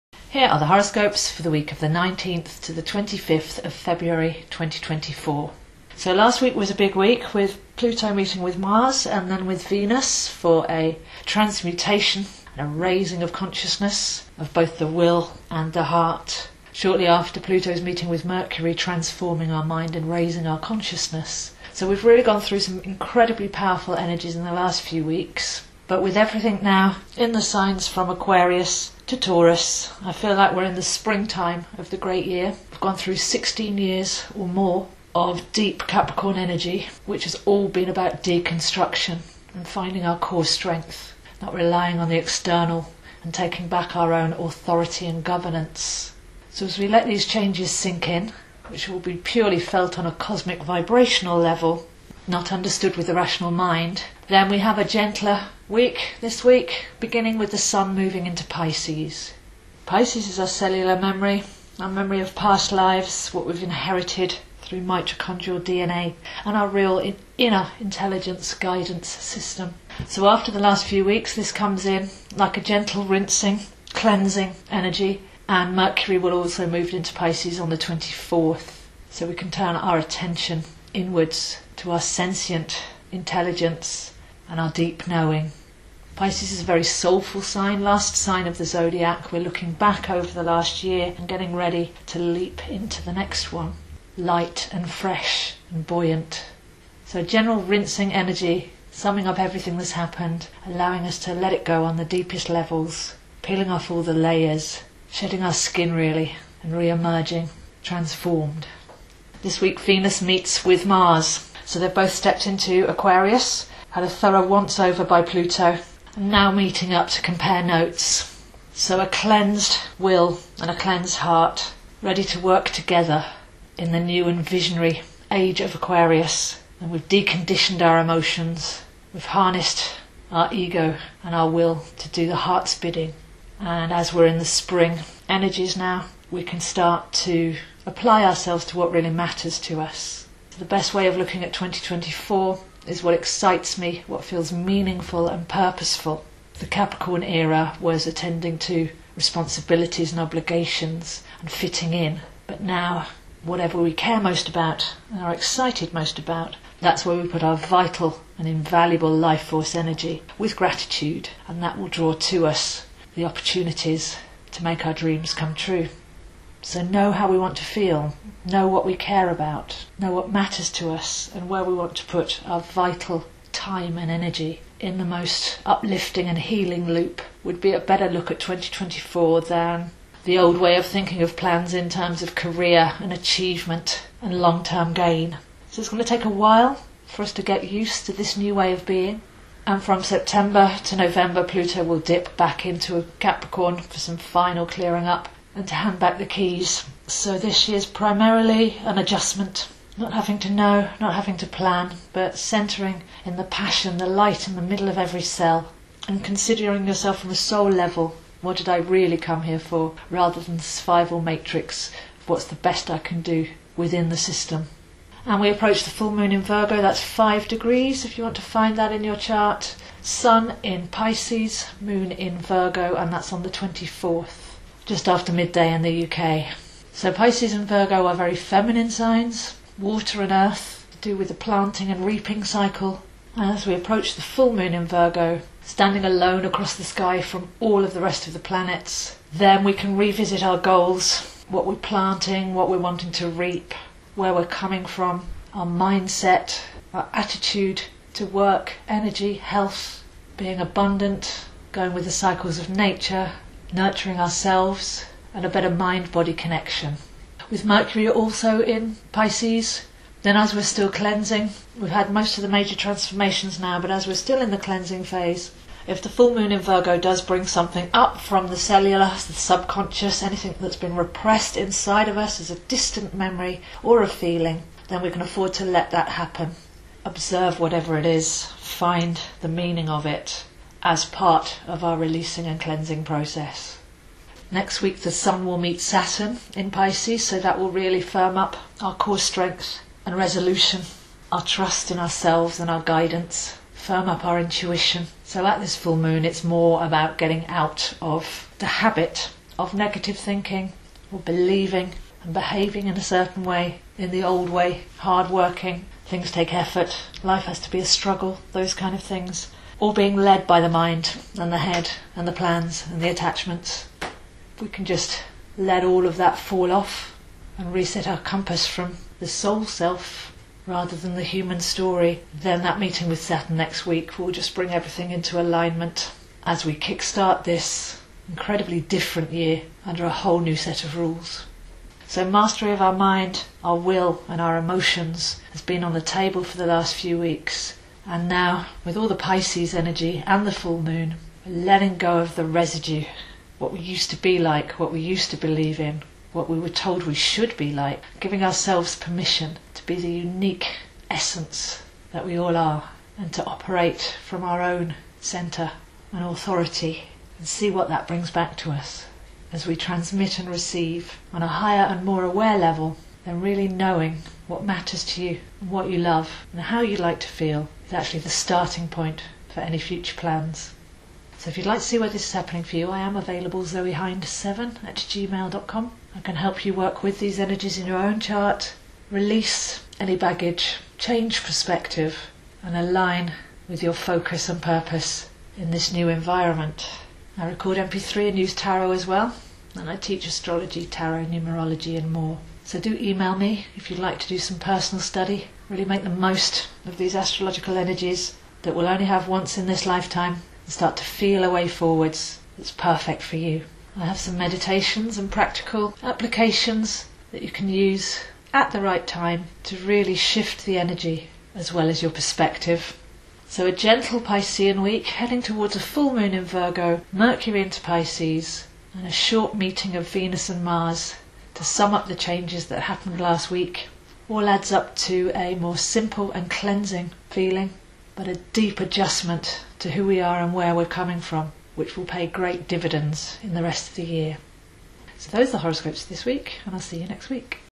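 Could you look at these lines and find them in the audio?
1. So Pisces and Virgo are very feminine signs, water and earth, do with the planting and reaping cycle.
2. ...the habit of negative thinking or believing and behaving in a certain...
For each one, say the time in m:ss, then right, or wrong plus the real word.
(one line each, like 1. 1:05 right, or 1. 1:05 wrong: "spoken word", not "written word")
1. 3:46 right
2. 4:58 right.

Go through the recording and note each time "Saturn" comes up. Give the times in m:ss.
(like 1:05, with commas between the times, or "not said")
4:45, 5:23.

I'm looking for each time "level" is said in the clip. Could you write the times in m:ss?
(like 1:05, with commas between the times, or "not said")
0:51, 1:42, 3:27, 6:02.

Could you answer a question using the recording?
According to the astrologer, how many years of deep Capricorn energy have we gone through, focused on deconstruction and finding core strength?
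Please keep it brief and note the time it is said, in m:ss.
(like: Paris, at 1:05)
16, at 0:33.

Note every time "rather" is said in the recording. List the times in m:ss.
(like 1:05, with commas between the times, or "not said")
3:30, 5:20.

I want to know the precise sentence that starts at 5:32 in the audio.
So, mastery of our mind, our will, and our emotions has been on the table for the last few weeks.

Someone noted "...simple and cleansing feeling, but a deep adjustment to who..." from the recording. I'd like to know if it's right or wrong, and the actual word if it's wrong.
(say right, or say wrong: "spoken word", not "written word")
right.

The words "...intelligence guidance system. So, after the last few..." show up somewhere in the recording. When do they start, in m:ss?
1:07.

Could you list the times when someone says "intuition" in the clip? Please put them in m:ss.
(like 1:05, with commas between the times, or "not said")
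4:54.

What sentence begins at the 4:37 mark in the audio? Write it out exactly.
Observe whatever it is, find the meaning of it, as part of our releasing and cleansing process.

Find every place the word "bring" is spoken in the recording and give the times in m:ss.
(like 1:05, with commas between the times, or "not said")
4:27, 5:24, 5:58.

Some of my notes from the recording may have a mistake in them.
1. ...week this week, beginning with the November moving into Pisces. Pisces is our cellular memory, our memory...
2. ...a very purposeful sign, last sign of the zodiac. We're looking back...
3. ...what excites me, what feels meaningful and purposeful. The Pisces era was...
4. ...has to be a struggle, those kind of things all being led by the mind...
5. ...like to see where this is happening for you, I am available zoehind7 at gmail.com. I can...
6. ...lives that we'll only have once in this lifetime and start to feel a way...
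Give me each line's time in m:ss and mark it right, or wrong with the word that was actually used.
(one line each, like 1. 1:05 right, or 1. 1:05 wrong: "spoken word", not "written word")
1. 0:55 wrong: "Sun", not "November"
2. 1:26 wrong: "soulful", not "purposeful"
3. 2:23 wrong: "Capricorn", not "Pisces"
4. 5:07 right
5. 6:11 right
6. 6:37 wrong: "energies", not "lives".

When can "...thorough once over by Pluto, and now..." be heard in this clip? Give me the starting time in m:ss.
1:54.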